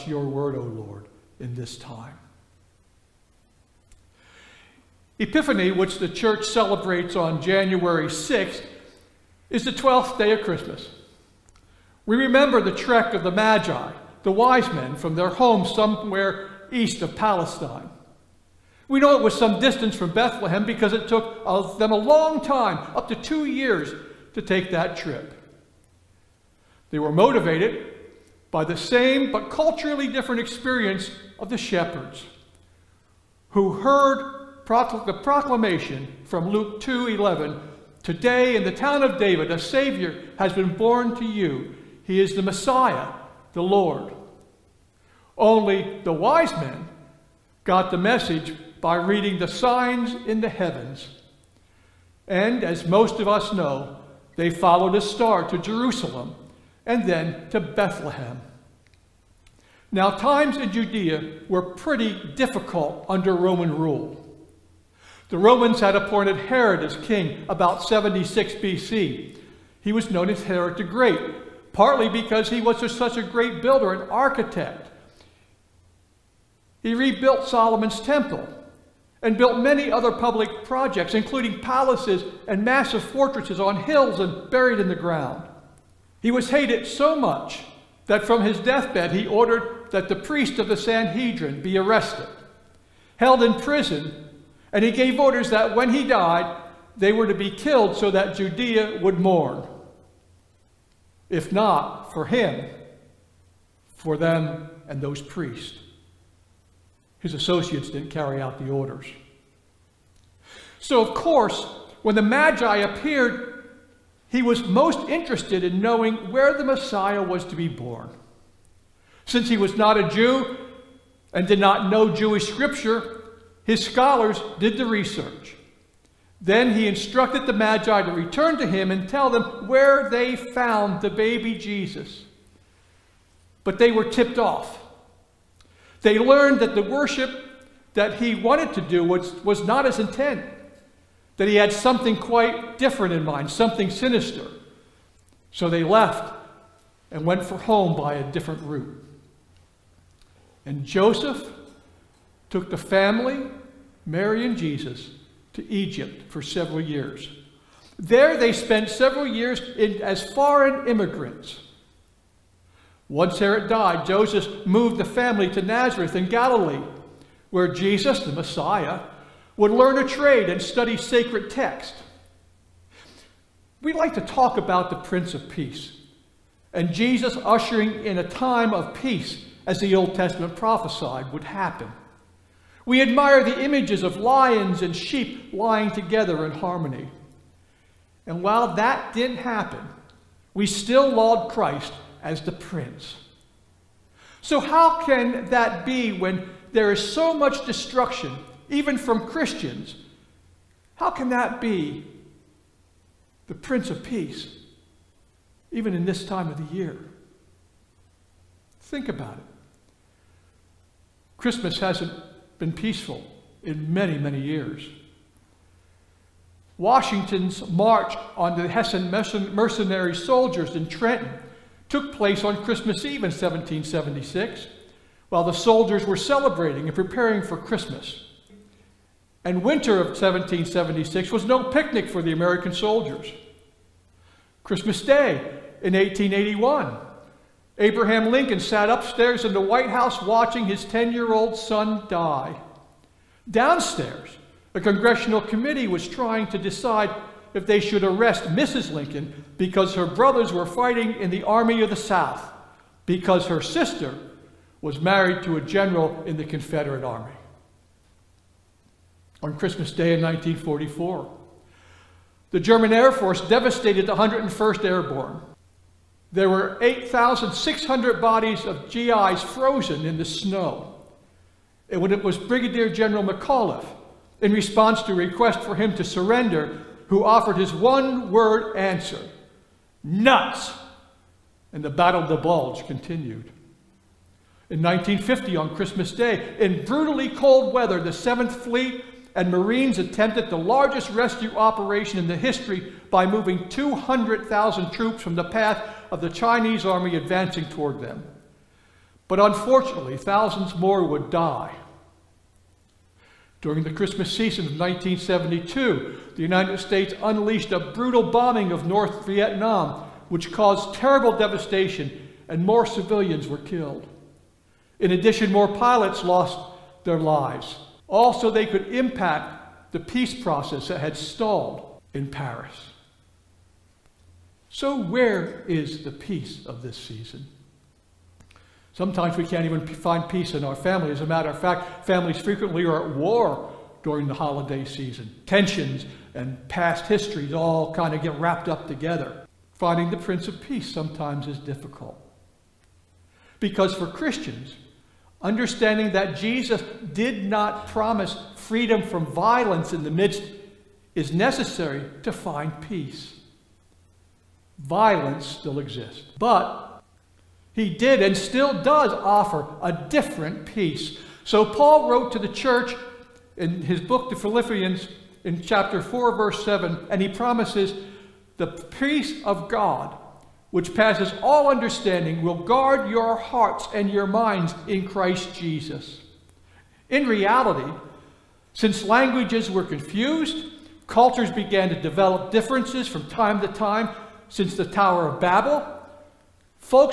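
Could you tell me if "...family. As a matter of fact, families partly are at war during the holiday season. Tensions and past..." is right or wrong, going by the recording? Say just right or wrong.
wrong.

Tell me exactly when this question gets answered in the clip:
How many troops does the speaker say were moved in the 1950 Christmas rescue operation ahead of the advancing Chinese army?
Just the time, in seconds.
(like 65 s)
293 s.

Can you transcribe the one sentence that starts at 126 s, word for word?
Then he instructed the Magi to return to him and tell them where they found the baby Jesus.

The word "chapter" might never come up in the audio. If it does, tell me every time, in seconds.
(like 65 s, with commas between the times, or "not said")
365 s.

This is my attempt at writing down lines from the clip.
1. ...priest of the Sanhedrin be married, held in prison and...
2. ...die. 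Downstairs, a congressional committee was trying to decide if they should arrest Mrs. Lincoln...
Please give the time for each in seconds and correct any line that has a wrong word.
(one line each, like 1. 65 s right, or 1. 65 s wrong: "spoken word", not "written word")
1. 90 s wrong: "arrested", not "married"
2. 242 s right.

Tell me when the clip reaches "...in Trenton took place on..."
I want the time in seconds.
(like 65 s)
220 s.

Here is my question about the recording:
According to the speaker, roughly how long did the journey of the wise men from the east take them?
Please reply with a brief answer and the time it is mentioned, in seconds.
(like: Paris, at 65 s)
up to two years, at 22 s.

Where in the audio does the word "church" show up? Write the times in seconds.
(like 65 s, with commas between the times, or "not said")
6 s, 362 s.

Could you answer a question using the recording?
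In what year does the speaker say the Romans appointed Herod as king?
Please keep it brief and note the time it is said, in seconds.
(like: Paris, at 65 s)
76 BC, at 67 s.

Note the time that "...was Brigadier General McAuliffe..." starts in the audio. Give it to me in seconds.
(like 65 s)
272 s.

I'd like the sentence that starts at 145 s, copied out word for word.
So they left and went for home by a different route.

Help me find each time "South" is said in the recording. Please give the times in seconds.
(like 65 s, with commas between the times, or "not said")
251 s.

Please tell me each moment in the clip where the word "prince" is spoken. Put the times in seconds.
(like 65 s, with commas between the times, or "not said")
174 s, 192 s, 203 s, 340 s.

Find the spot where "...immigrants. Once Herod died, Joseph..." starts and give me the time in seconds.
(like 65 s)
160 s.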